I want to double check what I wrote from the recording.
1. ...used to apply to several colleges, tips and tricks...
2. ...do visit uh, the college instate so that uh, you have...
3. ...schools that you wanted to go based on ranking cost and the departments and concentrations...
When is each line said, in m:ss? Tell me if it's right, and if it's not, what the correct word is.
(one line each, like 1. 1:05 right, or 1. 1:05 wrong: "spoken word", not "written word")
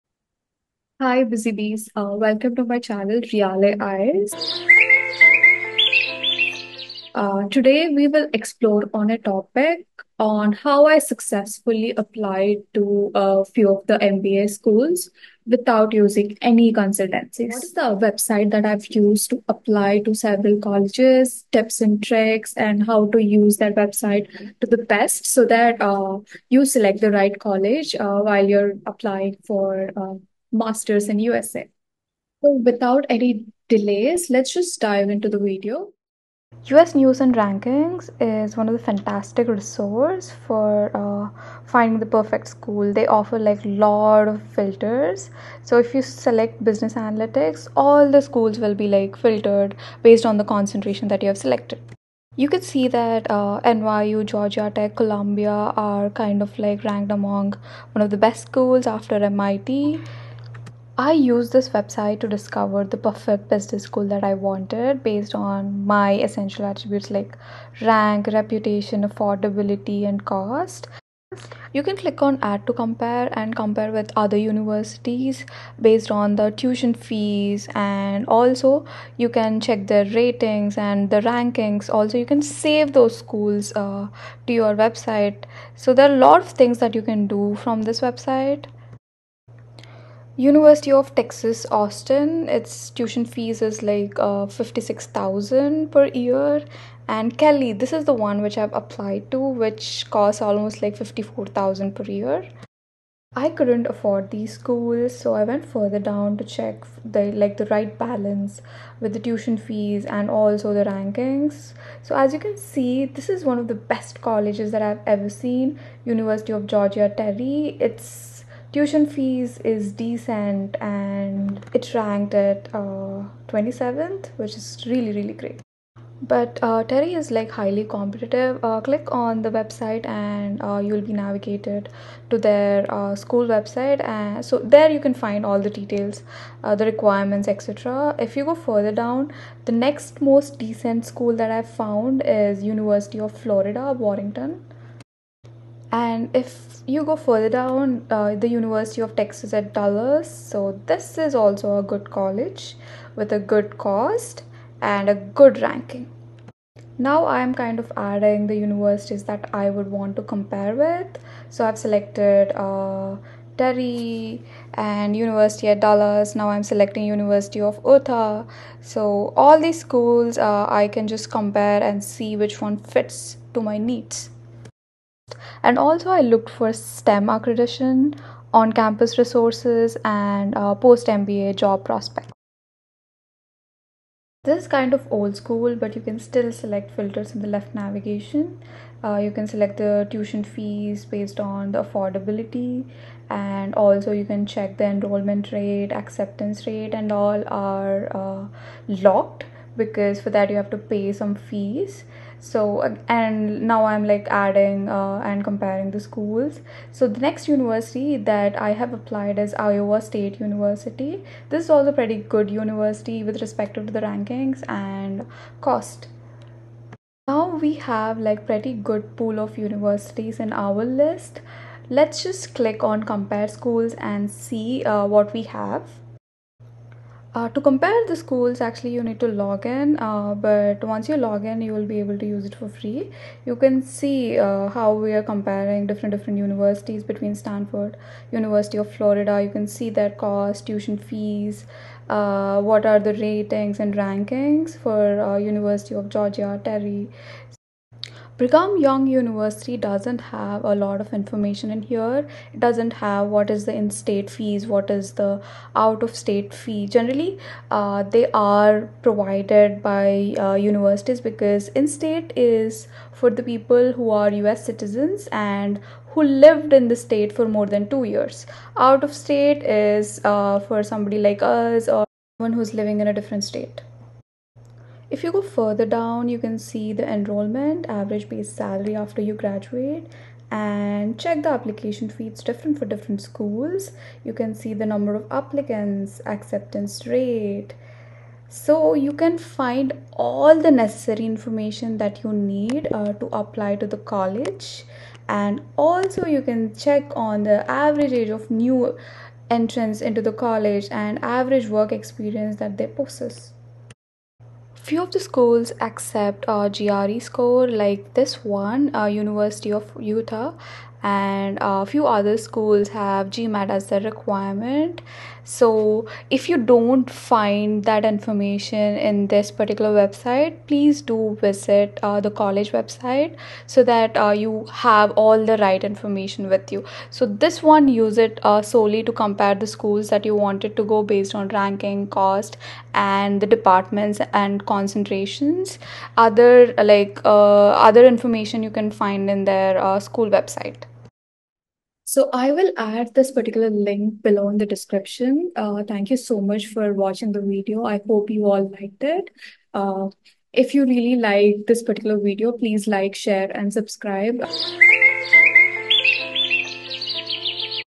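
1. 0:18 right
2. 5:21 wrong: "website", not "instate"
3. 5:29 right.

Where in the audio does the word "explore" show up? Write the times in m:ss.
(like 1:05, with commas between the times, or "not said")
0:08.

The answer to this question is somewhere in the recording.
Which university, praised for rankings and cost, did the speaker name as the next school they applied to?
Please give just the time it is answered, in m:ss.
3:29.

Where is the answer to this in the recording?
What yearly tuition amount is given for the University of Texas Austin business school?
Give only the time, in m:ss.
1:34.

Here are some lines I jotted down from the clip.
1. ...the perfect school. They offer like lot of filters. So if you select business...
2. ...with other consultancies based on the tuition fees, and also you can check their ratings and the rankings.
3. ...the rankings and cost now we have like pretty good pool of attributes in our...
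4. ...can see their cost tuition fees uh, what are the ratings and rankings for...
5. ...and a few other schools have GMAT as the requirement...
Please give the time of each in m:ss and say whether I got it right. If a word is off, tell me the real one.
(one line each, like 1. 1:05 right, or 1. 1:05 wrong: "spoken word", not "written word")
1. 0:41 right
2. 1:13 wrong: "universities", not "consultancies"
3. 3:33 wrong: "universities", not "attributes"
4. 3:59 right
5. 5:11 right.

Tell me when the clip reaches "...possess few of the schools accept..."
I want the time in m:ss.
5:02.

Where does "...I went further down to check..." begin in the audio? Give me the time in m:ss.
1:45.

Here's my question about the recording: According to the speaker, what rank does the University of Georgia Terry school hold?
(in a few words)
27th.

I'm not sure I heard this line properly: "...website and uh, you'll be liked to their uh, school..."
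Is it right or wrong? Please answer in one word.
wrong.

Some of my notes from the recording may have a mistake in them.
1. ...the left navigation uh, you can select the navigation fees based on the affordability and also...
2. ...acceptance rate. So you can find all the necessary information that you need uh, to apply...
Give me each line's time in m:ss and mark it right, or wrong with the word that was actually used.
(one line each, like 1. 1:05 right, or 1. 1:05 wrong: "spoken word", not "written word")
1. 3:07 wrong: "tuition", not "navigation"
2. 4:46 right.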